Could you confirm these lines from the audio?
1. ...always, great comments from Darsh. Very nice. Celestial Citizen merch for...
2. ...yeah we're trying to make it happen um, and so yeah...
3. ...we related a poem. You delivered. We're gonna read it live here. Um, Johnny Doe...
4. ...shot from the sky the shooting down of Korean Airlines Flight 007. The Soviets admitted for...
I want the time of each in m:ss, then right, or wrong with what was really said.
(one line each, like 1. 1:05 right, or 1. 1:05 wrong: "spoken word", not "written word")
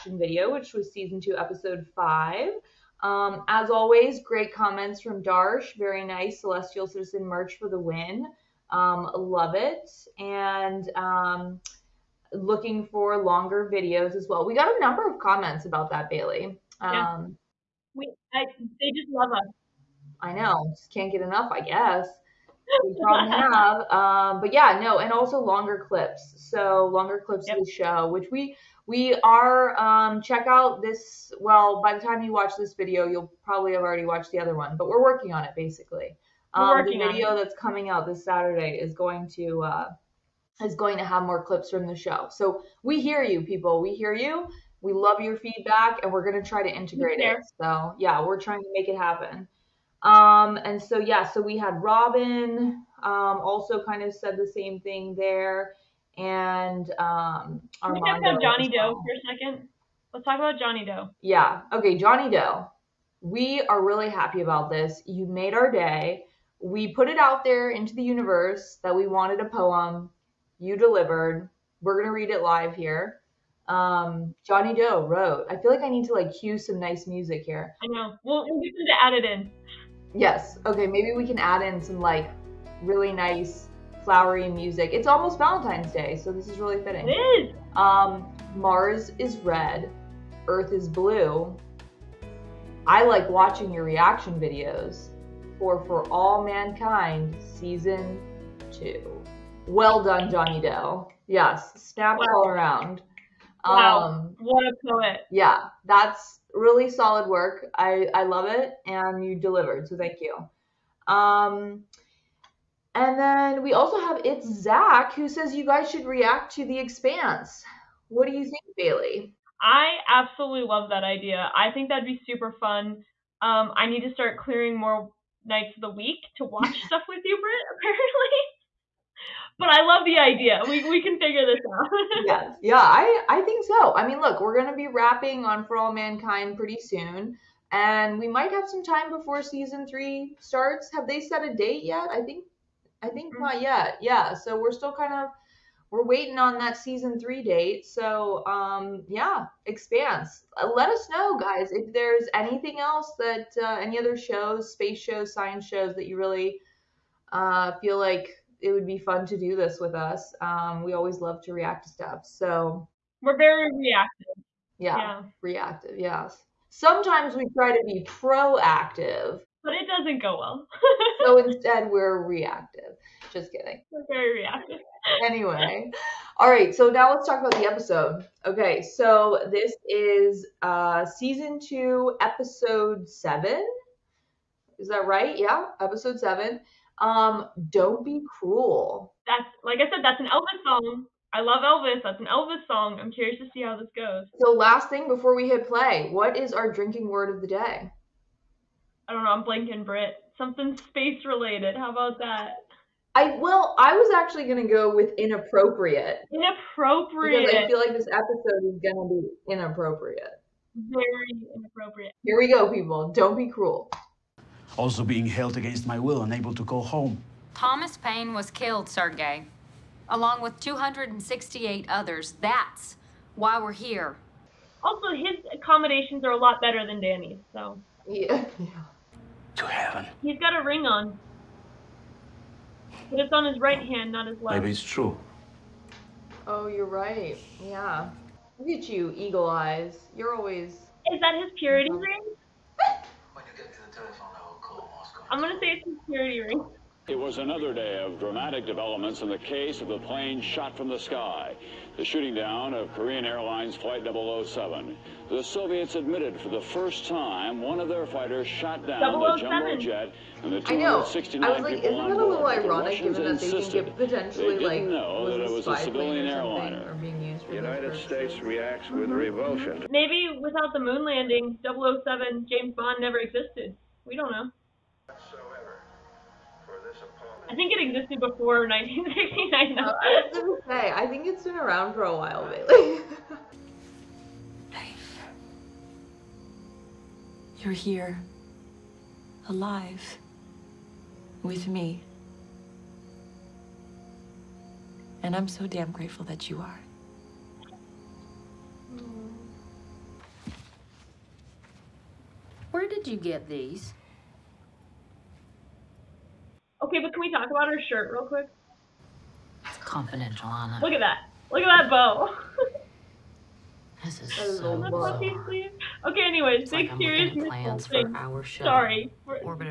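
1. 0:03 right
2. 0:47 right
3. 1:08 wrong: "wanted", not "related"
4. 4:10 right.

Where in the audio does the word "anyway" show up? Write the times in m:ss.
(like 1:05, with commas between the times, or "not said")
2:55, 5:16.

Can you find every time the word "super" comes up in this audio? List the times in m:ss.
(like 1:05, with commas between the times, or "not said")
2:02.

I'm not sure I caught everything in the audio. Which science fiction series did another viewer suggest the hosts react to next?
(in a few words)
The Expanse.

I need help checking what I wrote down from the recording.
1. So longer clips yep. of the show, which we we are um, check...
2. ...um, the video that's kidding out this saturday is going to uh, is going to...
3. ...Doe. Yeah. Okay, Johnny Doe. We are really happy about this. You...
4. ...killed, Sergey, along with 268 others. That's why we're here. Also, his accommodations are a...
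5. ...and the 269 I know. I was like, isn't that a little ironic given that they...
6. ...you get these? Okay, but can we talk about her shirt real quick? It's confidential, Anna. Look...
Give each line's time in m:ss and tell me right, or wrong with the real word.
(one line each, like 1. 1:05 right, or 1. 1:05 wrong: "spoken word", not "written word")
1. 0:26 right
2. 0:36 wrong: "coming", not "kidding"
3. 1:00 right
4. 3:38 right
5. 4:20 right
6. 5:03 right.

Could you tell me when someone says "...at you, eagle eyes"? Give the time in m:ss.
3:58.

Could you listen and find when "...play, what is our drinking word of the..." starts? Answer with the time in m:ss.
3:15.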